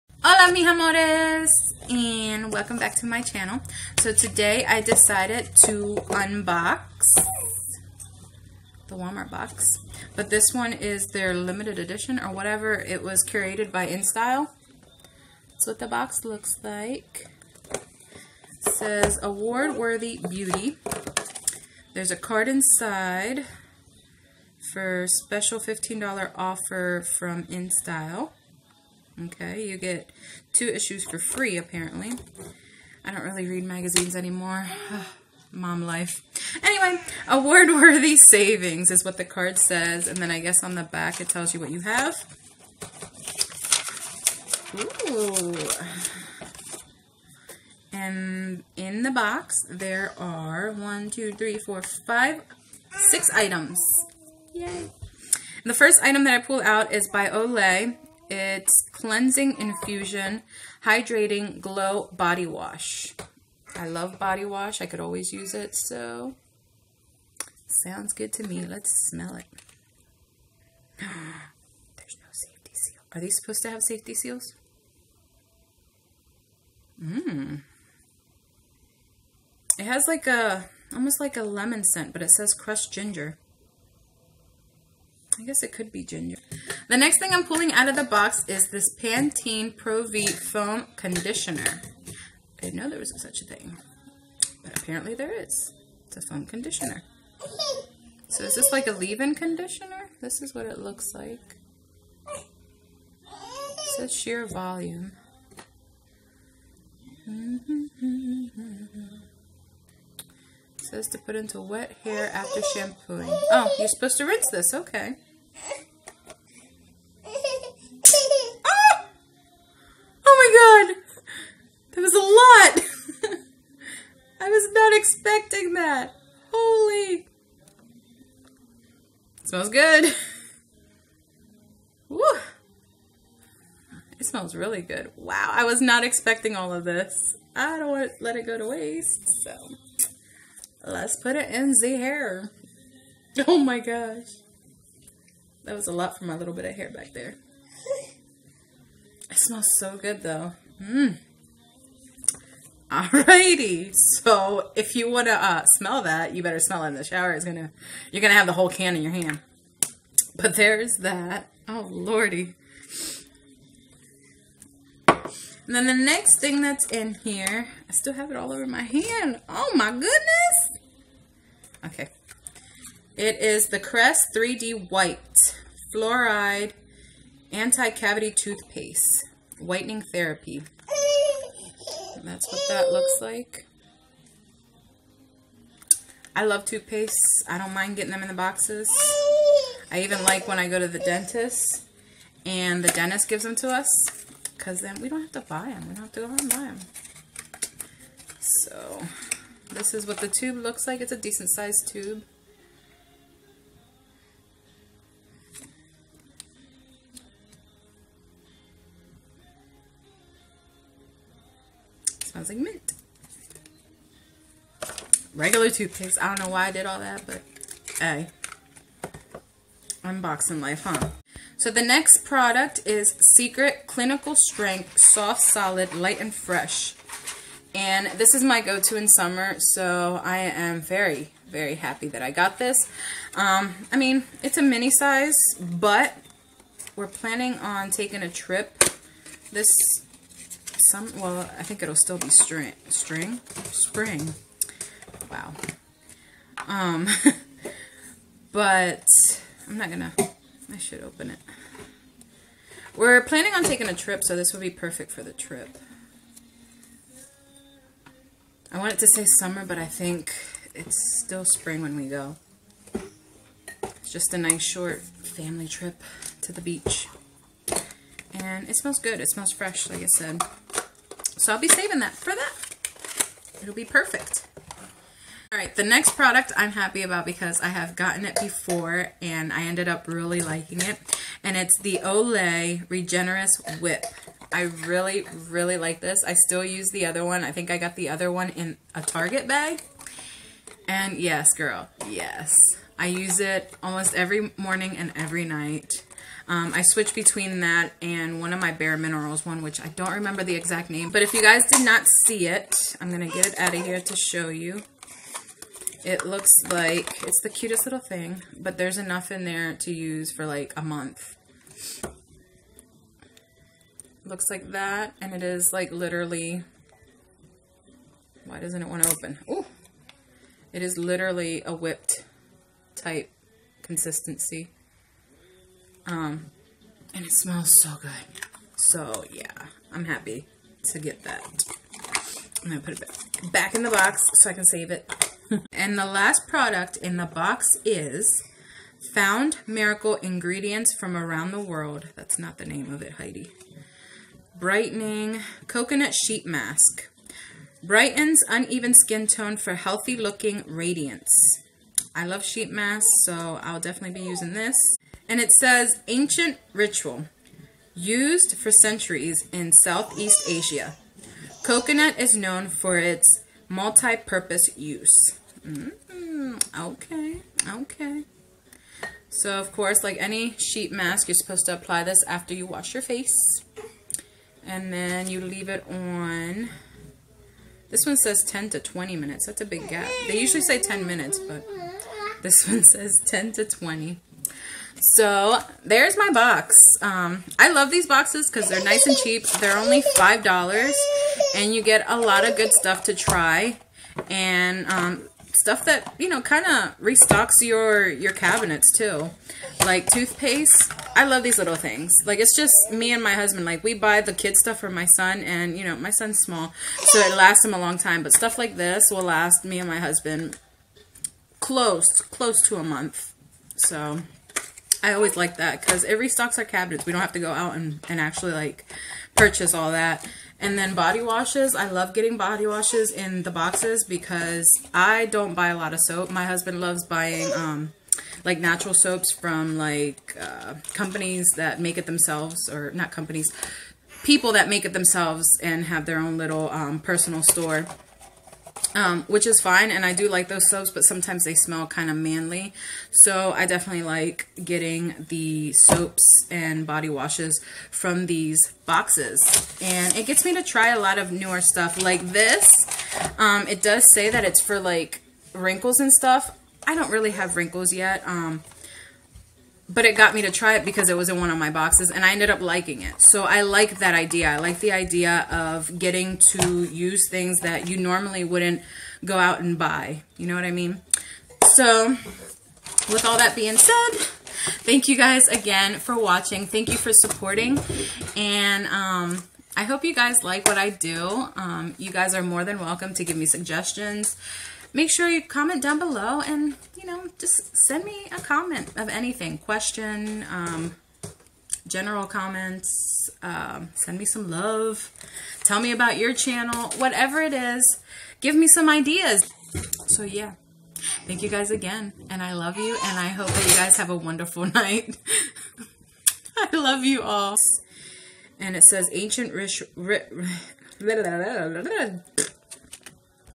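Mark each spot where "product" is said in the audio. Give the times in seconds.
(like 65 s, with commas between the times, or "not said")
222 s, 276 s, 336 s.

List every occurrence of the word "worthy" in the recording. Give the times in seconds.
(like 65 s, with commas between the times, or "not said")
19 s, 37 s.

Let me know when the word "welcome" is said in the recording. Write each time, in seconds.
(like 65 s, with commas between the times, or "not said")
2 s, 482 s.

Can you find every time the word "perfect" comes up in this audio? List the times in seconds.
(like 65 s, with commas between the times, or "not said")
254 s, 273 s.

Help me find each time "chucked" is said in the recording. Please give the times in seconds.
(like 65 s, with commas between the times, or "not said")
not said.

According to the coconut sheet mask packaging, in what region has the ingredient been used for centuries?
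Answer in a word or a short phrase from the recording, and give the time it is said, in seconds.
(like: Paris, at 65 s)
Southeast Asia, at 359 s.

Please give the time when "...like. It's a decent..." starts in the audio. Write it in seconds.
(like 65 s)
200 s.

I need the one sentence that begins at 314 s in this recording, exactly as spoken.
Looks like that, and it is like literally, why doesn't it want to open?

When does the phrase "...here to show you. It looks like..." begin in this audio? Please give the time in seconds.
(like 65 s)
303 s.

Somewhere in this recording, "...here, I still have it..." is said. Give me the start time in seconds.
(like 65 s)
167 s.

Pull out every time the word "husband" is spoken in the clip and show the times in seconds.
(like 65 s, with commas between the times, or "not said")
403 s, 409 s, 426 s.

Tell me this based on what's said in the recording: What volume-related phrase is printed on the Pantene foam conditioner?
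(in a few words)
Sheer volume.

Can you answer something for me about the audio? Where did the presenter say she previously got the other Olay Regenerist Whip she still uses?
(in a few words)
In a Target bag.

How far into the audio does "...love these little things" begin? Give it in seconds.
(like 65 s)
401 s.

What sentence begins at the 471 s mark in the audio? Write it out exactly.
So with all that being said, thank you guys again for watching.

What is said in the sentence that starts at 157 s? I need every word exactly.
It's gonna, you're gonna have the whole can in your hand.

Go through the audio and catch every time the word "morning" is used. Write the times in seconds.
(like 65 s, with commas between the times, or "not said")
294 s.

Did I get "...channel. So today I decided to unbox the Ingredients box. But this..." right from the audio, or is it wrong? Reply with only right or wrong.
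wrong.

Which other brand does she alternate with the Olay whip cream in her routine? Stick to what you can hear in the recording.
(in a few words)
Bare Minerals.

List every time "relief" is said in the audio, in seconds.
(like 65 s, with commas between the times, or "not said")
not said.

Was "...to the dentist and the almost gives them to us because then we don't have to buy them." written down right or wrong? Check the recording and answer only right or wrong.
wrong.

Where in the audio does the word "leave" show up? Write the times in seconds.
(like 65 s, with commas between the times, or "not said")
98 s, 375 s.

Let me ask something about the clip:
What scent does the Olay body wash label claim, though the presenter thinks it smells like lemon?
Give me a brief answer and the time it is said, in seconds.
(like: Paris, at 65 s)
Crushed ginger, at 82 s.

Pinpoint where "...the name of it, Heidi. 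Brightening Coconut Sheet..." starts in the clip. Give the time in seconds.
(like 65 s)
342 s.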